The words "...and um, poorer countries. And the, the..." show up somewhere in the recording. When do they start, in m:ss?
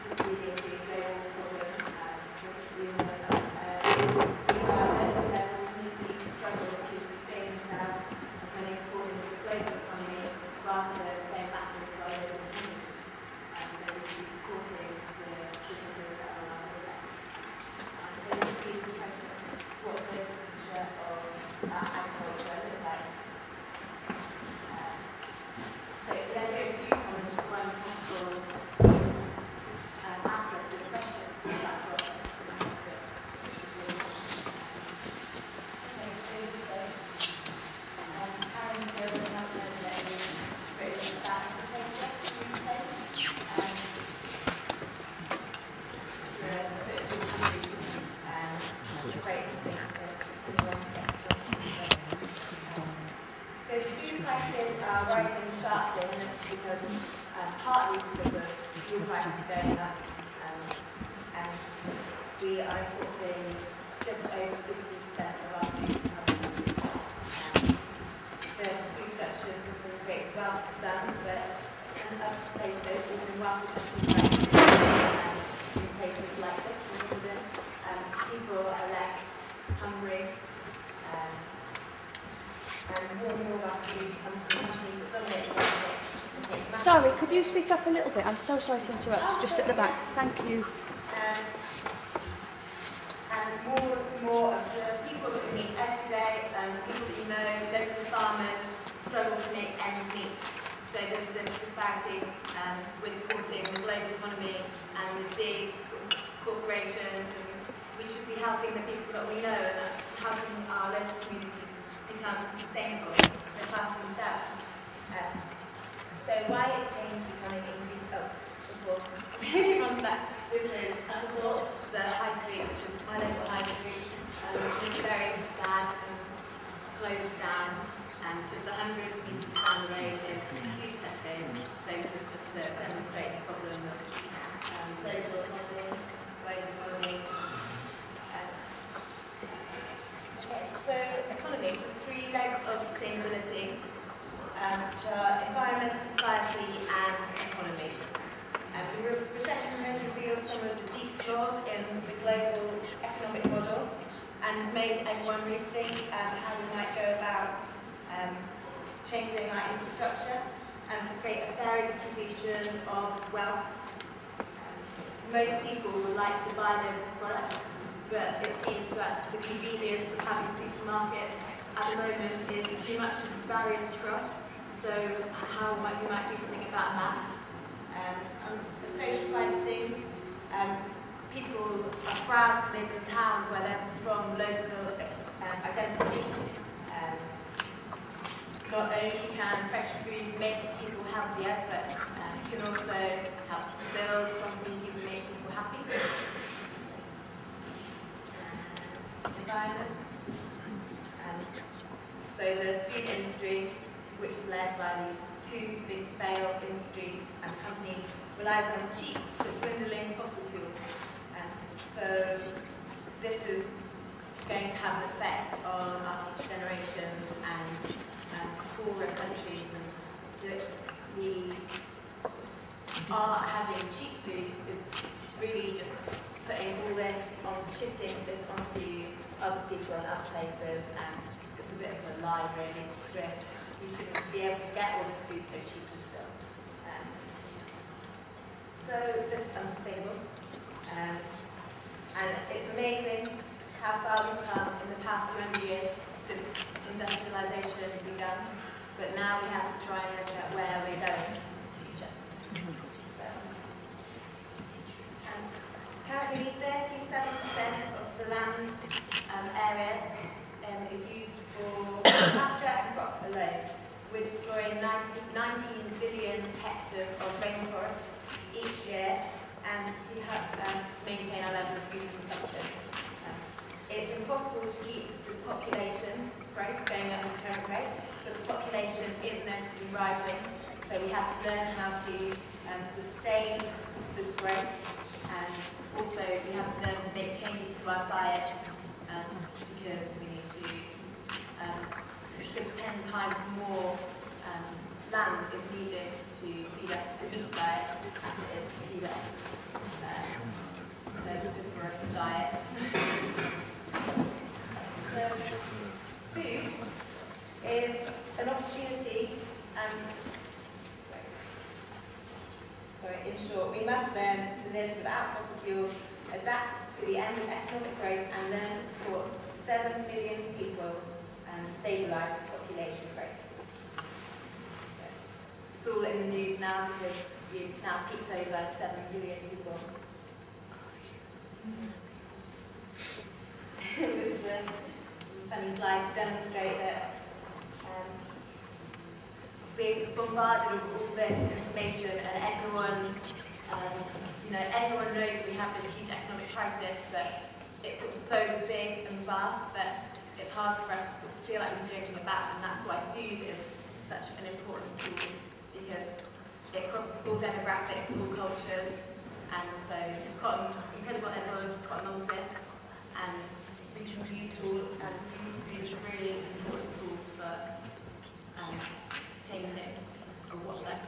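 3:37.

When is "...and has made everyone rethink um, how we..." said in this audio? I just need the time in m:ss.
2:34.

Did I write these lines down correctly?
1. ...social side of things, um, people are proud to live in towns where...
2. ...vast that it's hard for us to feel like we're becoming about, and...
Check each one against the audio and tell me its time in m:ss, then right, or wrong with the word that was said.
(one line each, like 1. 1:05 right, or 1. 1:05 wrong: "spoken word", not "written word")
1. 2:58 right
2. 5:49 wrong: "joking", not "becoming".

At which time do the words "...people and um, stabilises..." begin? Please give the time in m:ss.
5:20.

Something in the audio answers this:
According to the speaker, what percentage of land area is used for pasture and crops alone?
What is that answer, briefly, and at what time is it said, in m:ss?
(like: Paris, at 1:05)
37%, at 4:16.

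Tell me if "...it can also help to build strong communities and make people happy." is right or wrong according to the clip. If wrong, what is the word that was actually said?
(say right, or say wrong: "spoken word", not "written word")
right.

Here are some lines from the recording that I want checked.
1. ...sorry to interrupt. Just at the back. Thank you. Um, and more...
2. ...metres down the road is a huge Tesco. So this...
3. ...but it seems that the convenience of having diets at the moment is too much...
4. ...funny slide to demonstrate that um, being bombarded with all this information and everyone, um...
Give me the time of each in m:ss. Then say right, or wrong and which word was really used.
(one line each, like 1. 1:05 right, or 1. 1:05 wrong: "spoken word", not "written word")
1. 1:28 right
2. 2:09 right
3. 2:48 wrong: "supermarkets", not "diets"
4. 5:35 right.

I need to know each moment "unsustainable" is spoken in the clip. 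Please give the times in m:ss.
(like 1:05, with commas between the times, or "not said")
3:59.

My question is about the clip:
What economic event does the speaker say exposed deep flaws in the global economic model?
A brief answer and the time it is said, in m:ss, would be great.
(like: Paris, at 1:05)
the recession, at 2:28.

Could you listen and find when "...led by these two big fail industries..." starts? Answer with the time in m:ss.
3:24.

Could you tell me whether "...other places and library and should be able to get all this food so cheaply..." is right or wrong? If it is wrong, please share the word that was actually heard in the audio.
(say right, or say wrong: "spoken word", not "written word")
right.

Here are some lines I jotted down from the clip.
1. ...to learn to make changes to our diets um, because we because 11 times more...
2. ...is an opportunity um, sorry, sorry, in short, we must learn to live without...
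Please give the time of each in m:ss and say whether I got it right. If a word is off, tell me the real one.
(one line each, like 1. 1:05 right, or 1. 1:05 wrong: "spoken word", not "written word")
1. 4:46 wrong: "10", not "11"
2. 5:07 right.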